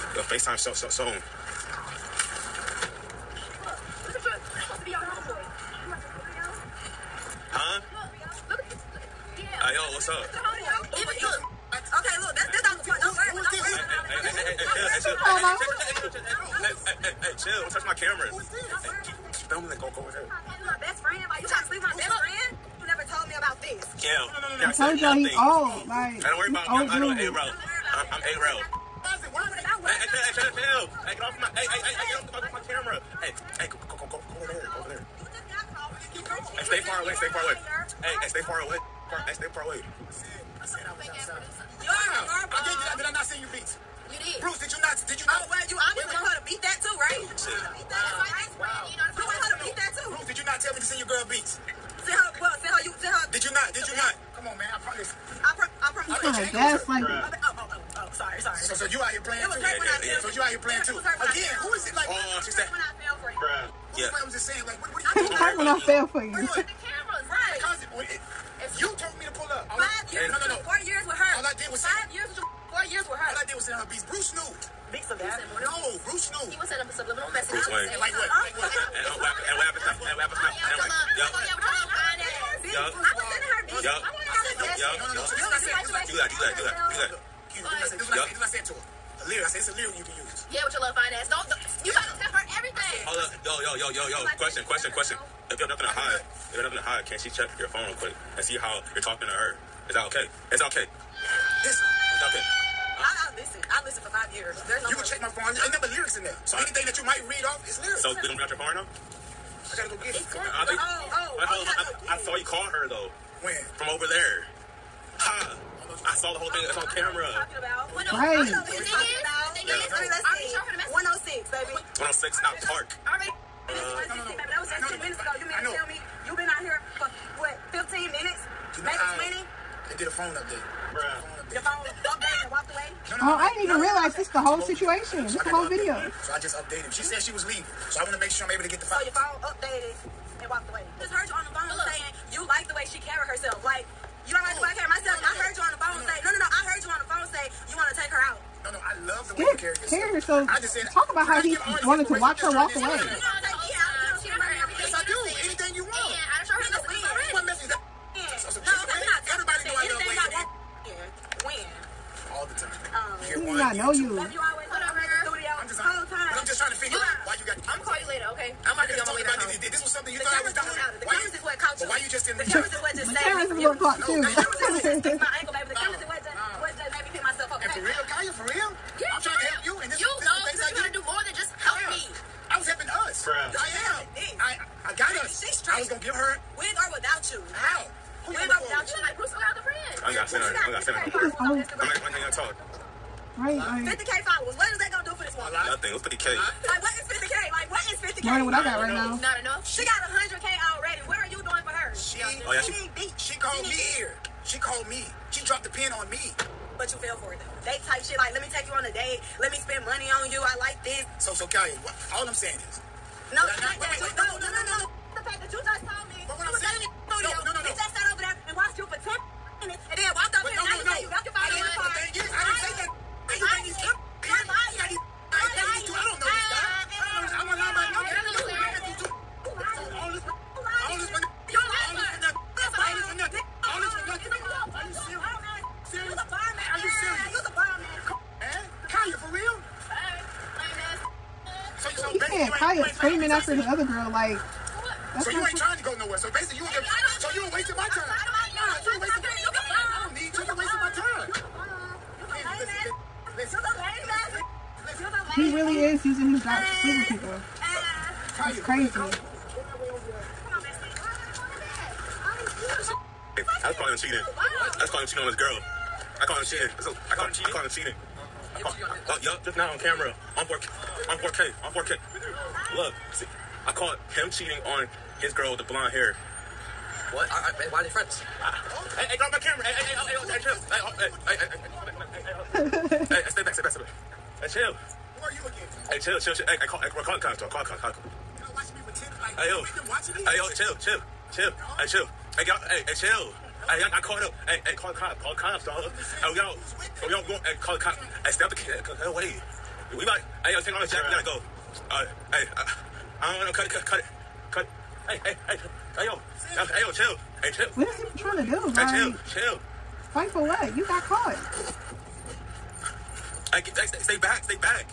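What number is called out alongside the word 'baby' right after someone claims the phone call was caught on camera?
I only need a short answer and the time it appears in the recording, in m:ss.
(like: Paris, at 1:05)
106, at 1:58.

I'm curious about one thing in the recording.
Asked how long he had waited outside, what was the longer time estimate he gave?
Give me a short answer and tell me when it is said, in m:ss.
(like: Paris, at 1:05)
20 minutes, at 2:08.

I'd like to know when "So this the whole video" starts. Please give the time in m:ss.
2:15.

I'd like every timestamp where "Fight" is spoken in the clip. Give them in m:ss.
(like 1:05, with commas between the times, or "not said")
5:10.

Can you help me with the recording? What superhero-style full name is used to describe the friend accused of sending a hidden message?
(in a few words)
Bruce Wayne.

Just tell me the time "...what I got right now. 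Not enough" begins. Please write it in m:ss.
3:18.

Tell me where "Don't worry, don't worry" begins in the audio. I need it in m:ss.
0:13.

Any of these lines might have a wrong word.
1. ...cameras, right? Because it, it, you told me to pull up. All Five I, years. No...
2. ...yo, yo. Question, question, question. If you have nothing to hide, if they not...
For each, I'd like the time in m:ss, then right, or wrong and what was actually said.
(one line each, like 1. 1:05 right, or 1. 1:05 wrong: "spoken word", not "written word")
1. 1:06 right
2. 1:33 right.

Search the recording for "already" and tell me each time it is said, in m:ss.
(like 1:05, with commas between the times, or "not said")
2:03, 3:20.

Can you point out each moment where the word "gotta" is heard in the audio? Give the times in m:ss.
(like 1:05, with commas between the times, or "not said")
1:31, 1:49, 5:01.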